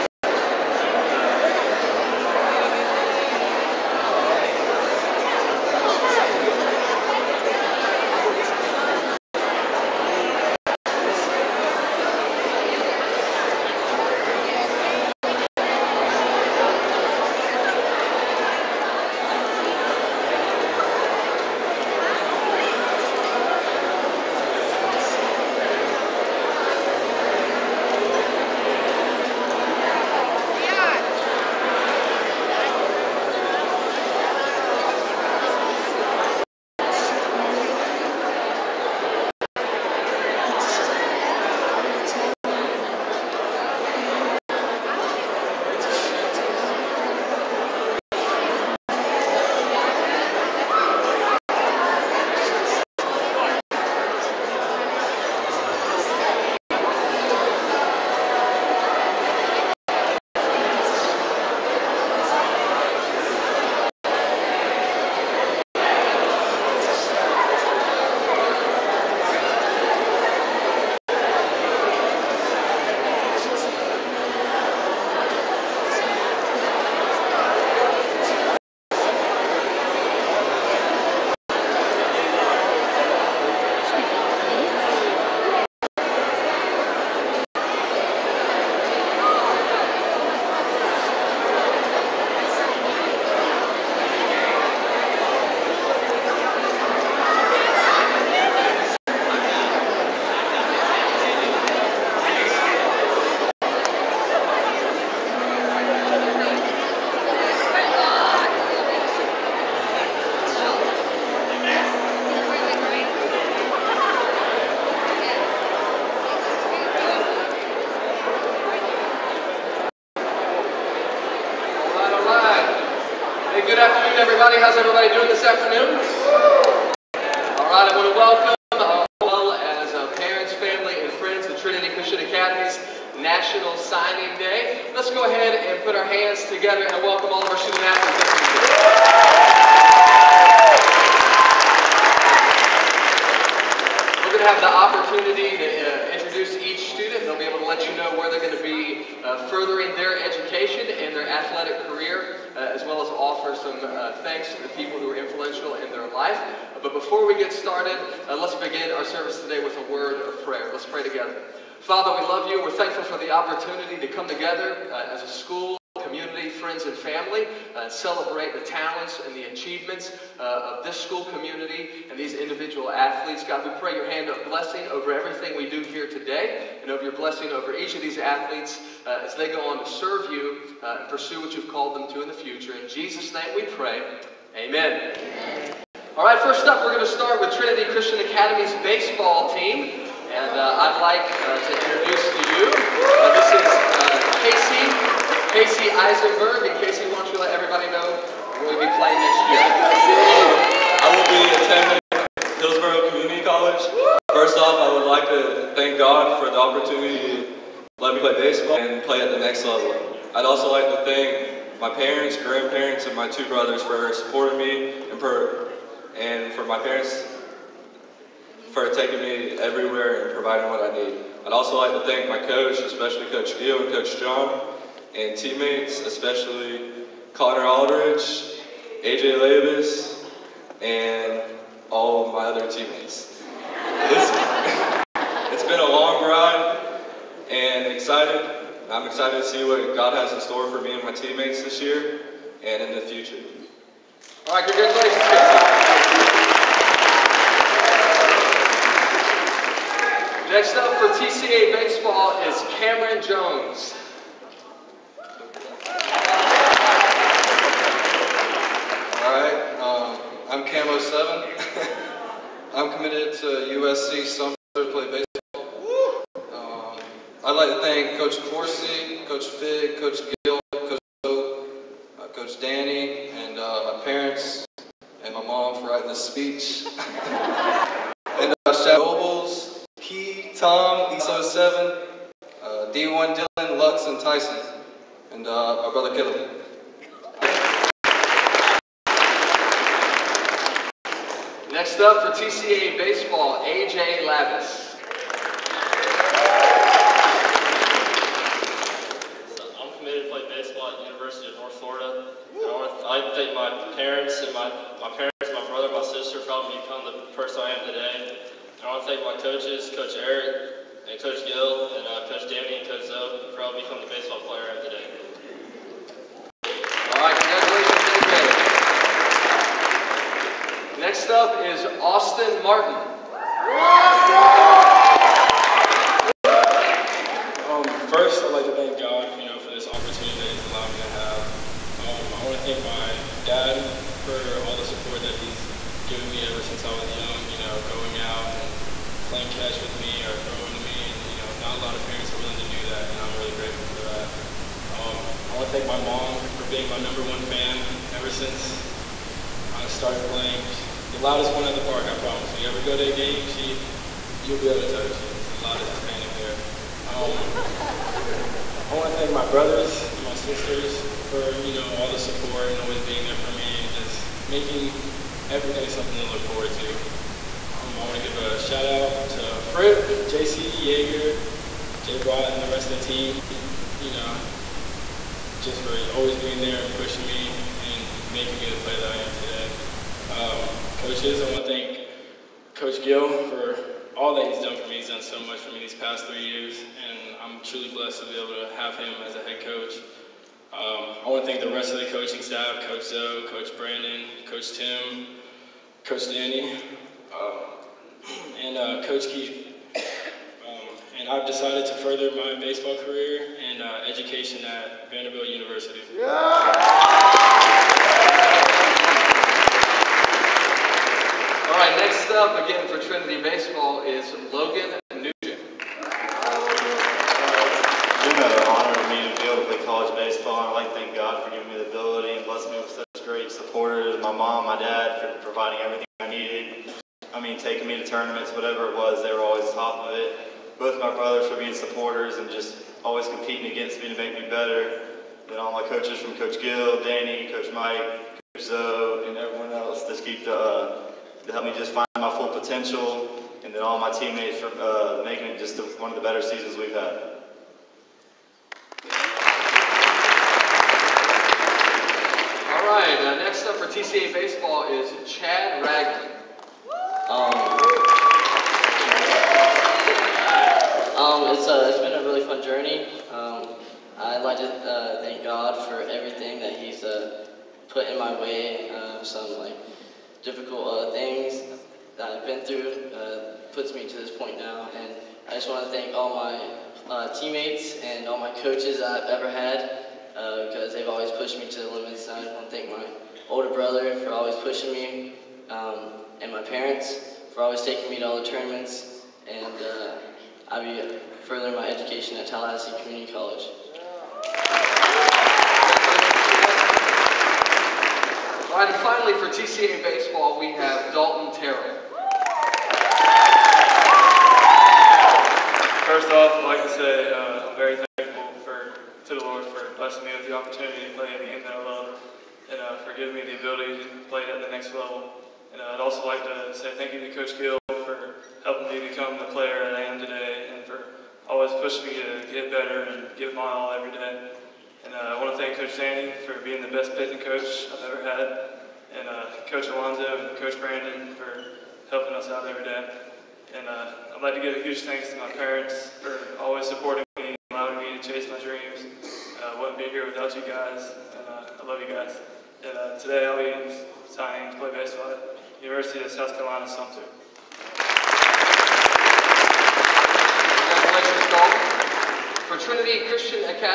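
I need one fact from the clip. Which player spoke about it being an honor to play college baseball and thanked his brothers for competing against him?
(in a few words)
Logan Nugent.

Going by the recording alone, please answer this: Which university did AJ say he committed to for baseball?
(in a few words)
University of North Florida.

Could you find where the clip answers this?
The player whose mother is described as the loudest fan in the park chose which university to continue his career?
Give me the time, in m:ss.
6:45.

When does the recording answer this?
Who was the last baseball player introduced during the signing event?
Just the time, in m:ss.
8:21.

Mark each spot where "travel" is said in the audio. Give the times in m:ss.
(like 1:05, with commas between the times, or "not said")
not said.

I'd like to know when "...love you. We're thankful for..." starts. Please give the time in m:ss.
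2:42.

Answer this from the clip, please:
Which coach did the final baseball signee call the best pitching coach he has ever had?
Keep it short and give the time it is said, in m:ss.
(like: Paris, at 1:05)
Coach Sandy, at 8:45.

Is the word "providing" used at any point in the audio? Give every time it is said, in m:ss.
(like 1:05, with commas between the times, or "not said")
3:40, 7:05.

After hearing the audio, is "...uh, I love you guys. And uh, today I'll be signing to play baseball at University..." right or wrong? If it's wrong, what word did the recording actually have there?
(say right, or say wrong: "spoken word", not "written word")
right.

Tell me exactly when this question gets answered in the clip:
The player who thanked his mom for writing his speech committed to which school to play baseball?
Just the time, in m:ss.
4:23.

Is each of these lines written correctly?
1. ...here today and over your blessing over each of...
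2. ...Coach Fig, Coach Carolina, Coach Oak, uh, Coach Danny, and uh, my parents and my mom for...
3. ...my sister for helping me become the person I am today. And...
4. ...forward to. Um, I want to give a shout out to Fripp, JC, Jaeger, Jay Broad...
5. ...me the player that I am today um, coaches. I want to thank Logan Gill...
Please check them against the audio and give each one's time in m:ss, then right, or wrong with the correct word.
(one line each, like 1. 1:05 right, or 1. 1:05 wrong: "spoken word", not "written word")
1. 2:55 right
2. 4:29 wrong: "Gill", not "Carolina"
3. 5:05 right
4. 6:06 right
5. 6:18 wrong: "Coach", not "Logan".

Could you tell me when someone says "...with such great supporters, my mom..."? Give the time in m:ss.
7:02.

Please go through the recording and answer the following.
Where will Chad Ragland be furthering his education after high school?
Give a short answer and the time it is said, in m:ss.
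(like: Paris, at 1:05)
Tallahassee Community College, at 8:12.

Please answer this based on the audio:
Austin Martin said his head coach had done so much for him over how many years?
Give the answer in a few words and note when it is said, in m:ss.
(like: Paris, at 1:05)
3, at 6:26.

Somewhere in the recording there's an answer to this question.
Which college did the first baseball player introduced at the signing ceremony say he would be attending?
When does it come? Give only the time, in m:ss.
3:22.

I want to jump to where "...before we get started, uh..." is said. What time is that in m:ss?
2:36.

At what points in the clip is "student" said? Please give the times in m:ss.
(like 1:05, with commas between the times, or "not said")
2:17, 2:26.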